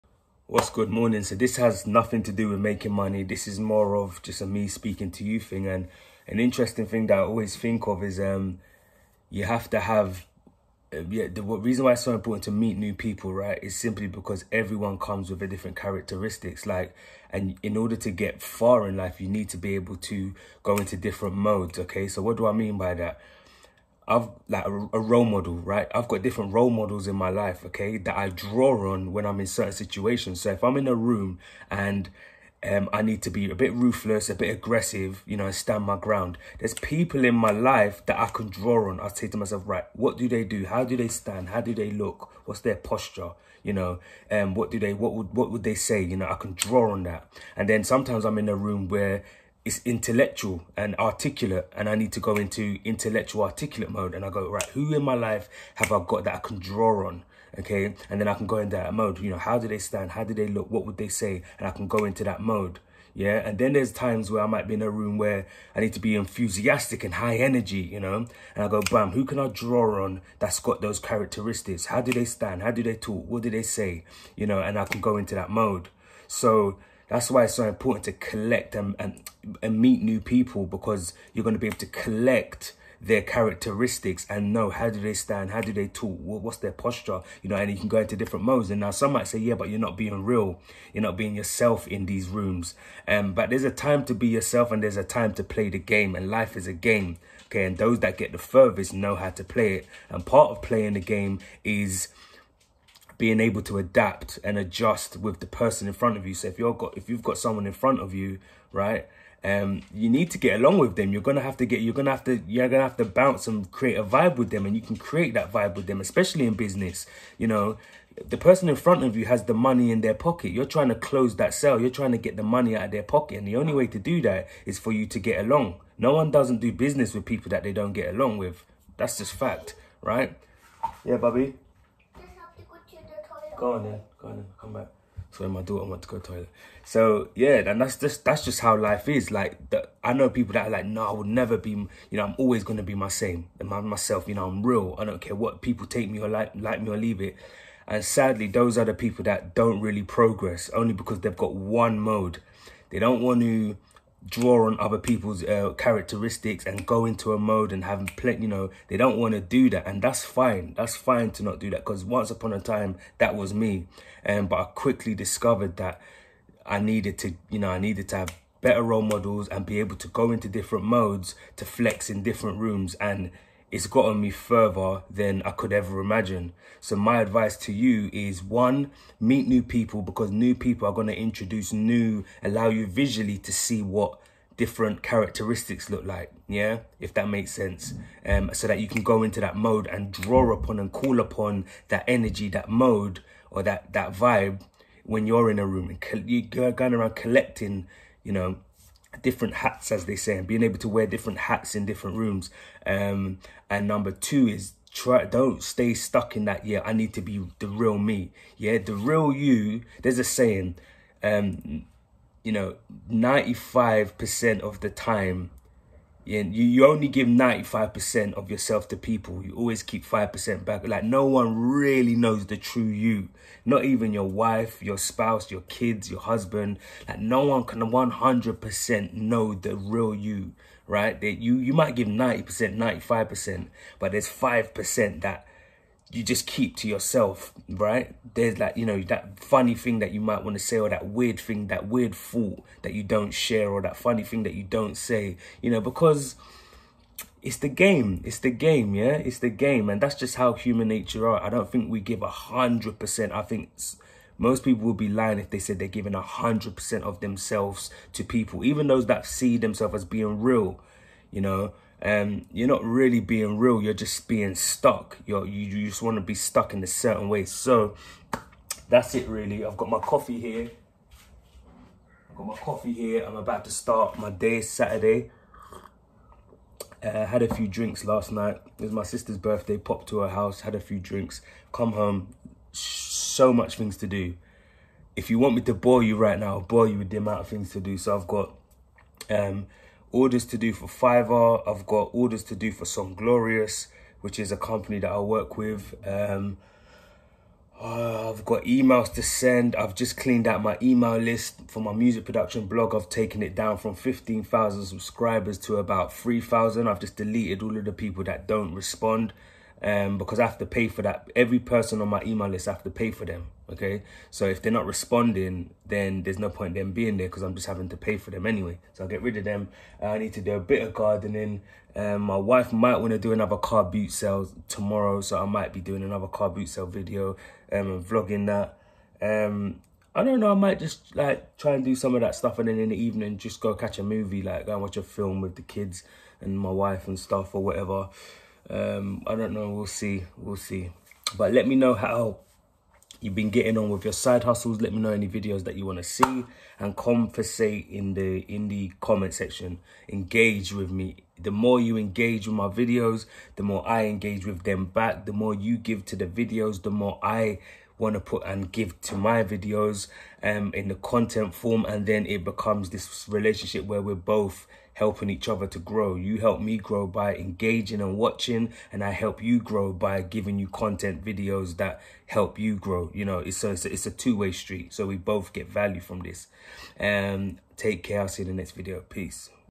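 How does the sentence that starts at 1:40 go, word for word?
And part of playing the game is being able to adapt and adjust with the person in front of you.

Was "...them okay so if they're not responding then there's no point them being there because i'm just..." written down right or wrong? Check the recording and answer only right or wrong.
right.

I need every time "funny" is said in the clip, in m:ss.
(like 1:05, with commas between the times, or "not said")
3:59, 4:03.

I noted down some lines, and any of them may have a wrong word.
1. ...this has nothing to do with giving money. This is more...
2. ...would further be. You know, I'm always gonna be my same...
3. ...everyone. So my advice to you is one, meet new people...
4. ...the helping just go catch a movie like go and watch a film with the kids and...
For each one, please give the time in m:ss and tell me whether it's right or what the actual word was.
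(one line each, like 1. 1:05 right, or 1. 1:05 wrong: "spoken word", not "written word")
1. 0:01 wrong: "making", not "giving"
2. 2:21 wrong: "never", not "further"
3. 2:56 wrong: "imagine", not "everyone"
4. 5:32 wrong: "evening", not "helping".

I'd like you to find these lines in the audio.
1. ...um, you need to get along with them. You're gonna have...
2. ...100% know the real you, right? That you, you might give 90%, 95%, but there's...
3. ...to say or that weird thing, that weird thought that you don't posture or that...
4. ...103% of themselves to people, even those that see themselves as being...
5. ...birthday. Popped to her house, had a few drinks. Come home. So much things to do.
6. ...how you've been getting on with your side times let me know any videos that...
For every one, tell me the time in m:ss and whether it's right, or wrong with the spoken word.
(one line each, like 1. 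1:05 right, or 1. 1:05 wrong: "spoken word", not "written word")
1. 1:49 right
2. 3:47 right
3. 4:00 wrong: "share", not "posture"
4. 4:16 wrong: "100", not "103"
5. 4:39 right
6. 5:41 wrong: "hustles", not "times".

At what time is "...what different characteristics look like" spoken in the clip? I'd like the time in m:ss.
3:03.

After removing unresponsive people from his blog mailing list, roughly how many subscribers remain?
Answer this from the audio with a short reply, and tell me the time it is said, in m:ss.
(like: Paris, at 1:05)
3,000, at 5:06.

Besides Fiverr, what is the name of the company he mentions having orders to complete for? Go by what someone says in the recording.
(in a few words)
Some Glorious.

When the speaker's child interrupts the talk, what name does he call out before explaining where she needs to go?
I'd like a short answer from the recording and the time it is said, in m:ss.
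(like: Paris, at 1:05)
Bobby, at 2:11.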